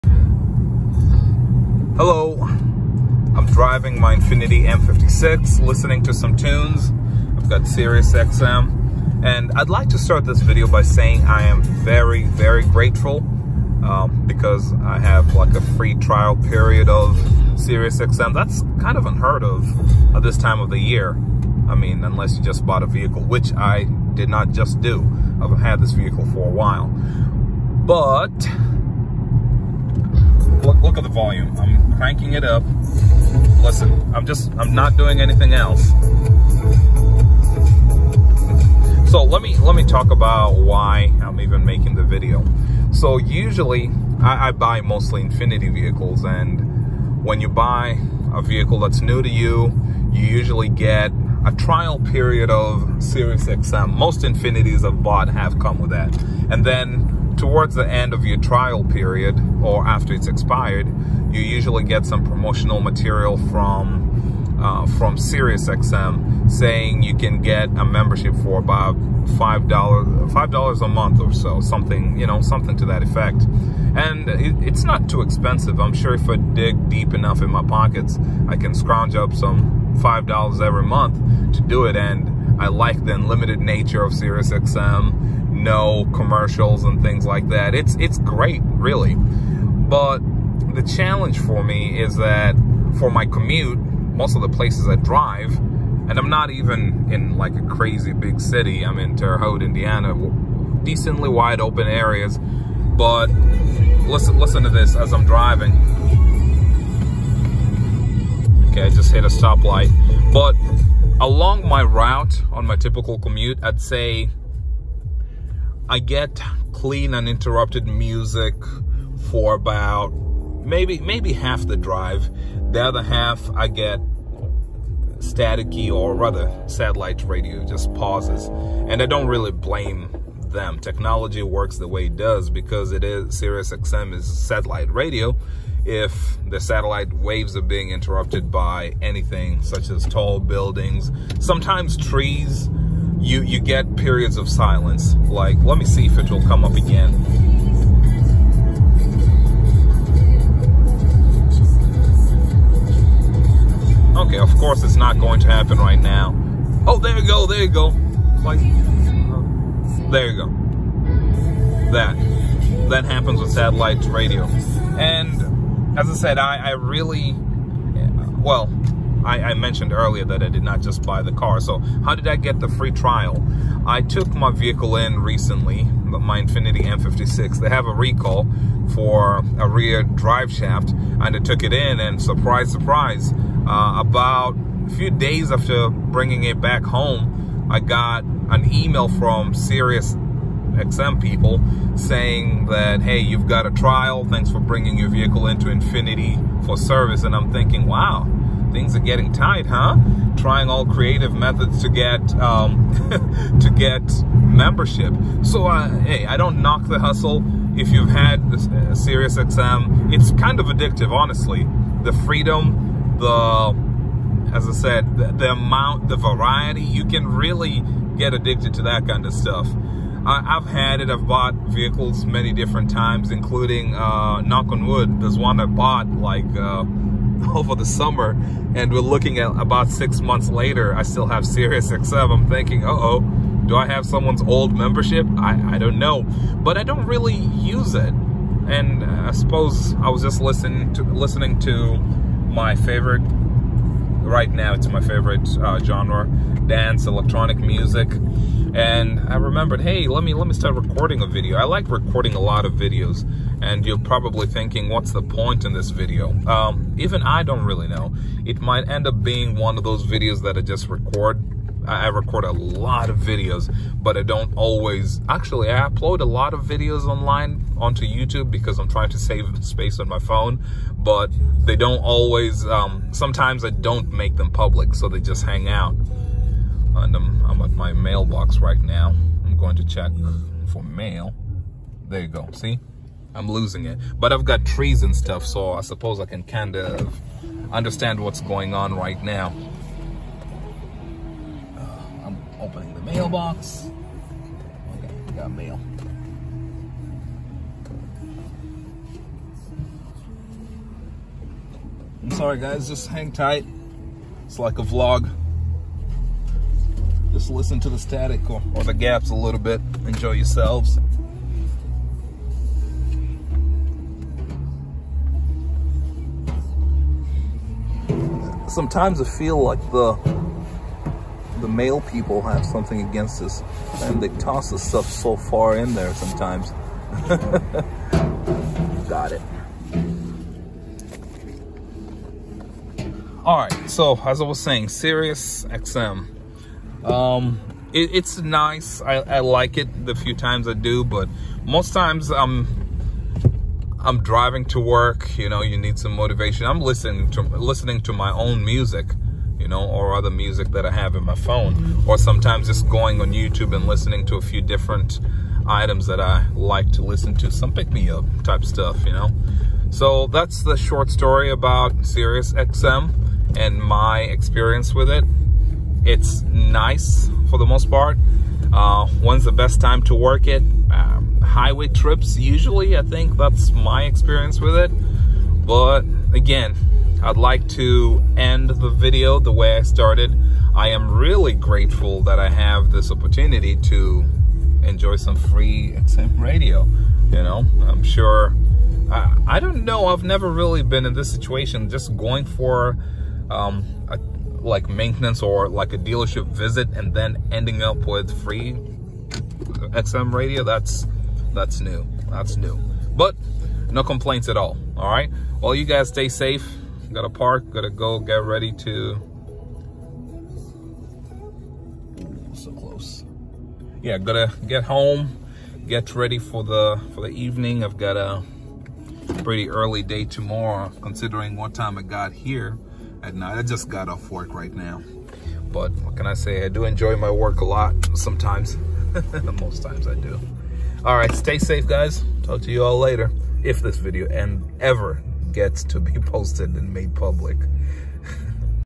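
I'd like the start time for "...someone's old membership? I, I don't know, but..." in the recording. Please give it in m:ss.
3:54.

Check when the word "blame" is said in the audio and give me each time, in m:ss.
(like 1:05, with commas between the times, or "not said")
2:09.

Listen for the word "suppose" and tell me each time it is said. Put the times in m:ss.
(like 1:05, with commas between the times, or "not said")
3:59, 4:45.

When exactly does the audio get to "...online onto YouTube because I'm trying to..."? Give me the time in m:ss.
4:27.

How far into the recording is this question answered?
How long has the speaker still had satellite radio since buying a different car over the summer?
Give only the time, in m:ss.
3:49.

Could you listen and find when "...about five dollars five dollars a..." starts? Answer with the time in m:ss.
1:08.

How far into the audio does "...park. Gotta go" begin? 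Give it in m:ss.
6:47.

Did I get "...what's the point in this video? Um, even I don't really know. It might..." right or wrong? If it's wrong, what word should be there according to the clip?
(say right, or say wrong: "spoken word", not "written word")
right.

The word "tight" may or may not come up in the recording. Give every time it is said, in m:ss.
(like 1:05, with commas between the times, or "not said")
3:19, 5:03.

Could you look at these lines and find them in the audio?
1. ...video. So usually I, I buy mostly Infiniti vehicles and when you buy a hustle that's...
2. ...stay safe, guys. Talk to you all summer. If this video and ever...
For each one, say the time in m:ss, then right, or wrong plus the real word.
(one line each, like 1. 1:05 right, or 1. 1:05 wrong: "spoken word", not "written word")
1. 0:42 wrong: "vehicle", not "hustle"
2. 7:11 wrong: "later", not "summer".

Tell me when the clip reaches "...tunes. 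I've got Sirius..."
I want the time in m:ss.
0:06.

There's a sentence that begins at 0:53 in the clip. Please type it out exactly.
Most Infinitis I've bought have come with that.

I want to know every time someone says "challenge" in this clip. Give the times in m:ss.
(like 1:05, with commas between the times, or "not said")
1:30.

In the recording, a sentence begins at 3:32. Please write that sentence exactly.
The freedom, the as I said, the, the amount, the variety, you can really get addicted to that kind of stuff.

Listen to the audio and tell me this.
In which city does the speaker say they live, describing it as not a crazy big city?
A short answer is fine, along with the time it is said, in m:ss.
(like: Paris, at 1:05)
Terre Haute, Indiana, at 1:39.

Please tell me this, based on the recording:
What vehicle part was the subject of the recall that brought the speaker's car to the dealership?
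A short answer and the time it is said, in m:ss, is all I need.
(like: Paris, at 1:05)
rear drive shaft, at 2:59.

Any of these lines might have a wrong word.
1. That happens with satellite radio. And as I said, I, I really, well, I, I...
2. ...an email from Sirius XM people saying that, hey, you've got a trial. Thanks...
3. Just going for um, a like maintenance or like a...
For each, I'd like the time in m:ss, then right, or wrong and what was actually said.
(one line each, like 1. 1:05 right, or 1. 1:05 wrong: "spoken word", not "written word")
1. 2:42 right
2. 3:08 right
3. 6:31 right.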